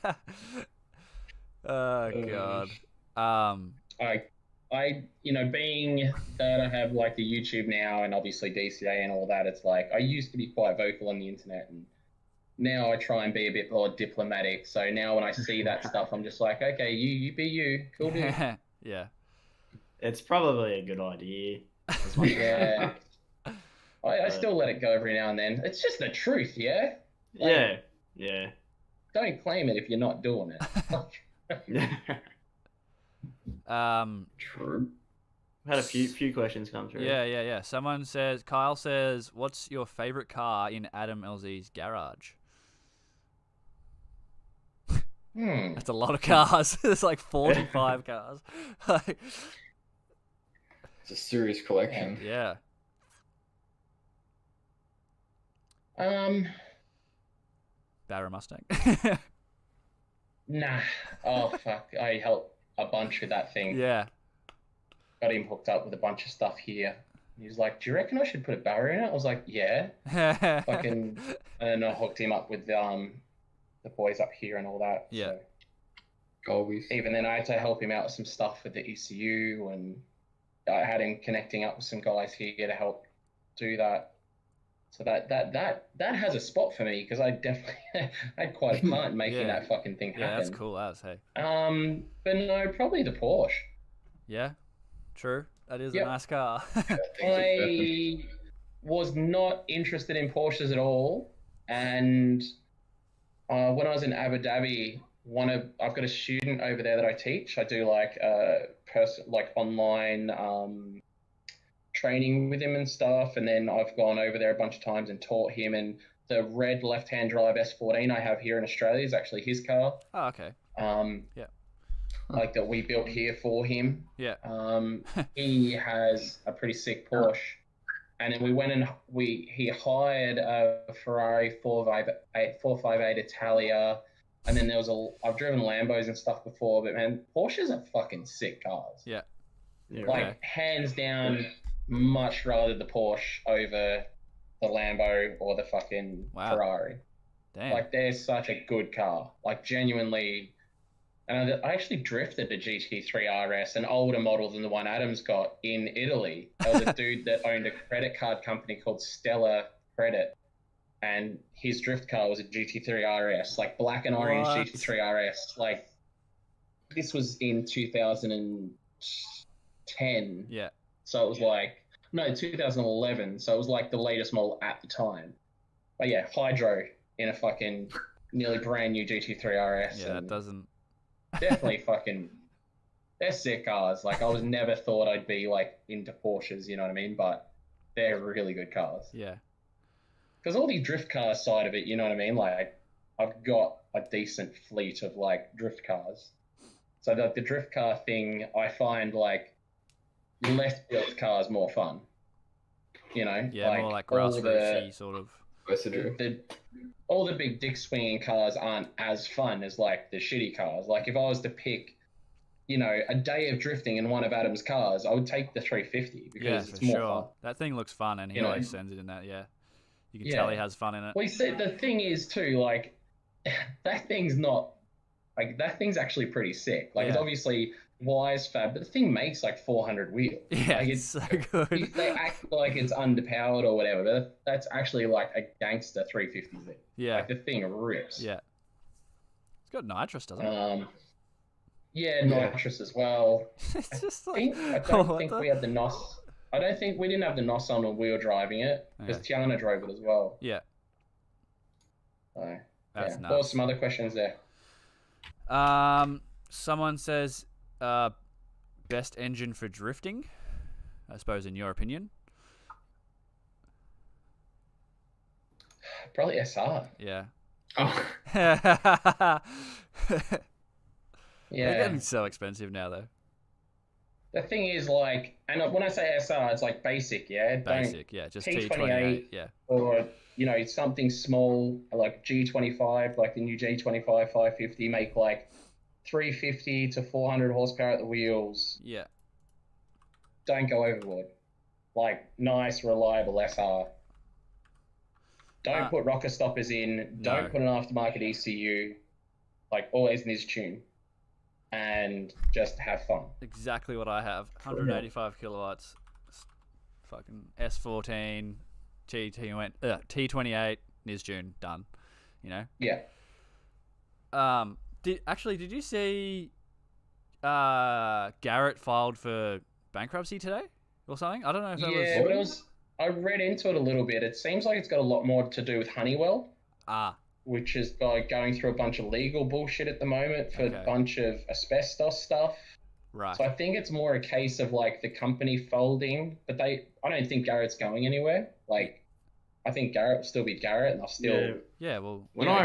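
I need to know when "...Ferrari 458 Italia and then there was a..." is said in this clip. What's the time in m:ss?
2:11.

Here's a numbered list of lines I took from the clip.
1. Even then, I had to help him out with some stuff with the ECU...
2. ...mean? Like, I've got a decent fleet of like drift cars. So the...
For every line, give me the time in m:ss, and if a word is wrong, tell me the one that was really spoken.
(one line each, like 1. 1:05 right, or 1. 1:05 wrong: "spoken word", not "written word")
1. 1:16 right
2. 3:12 right.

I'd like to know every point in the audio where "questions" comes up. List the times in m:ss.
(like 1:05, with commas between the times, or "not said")
0:36, 4:13.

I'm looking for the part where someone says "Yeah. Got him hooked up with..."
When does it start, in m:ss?
1:03.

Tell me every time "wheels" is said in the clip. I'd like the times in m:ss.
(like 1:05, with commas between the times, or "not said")
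3:50, 4:48.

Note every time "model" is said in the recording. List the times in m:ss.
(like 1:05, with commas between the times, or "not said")
2:34, 2:54.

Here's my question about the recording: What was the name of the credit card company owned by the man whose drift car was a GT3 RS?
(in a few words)
Stellar Credit.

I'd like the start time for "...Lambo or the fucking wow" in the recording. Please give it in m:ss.
2:24.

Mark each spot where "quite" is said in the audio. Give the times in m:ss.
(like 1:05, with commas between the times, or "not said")
0:10, 1:28.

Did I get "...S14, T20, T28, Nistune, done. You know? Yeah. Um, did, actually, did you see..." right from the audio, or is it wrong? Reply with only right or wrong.
right.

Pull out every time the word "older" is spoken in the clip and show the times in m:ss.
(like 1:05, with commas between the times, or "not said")
2:33.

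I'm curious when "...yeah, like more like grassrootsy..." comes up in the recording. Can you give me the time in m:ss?
3:23.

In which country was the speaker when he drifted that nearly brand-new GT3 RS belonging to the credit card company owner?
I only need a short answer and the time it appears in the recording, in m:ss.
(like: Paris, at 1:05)
Italy, at 2:35.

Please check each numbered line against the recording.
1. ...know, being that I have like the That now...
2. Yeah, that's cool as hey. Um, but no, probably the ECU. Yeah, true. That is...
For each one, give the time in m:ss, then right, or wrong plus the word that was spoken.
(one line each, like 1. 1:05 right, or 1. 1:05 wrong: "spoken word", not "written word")
1. 0:05 wrong: "YouTube", not "That"
2. 1:30 wrong: "Porsche", not "ECU".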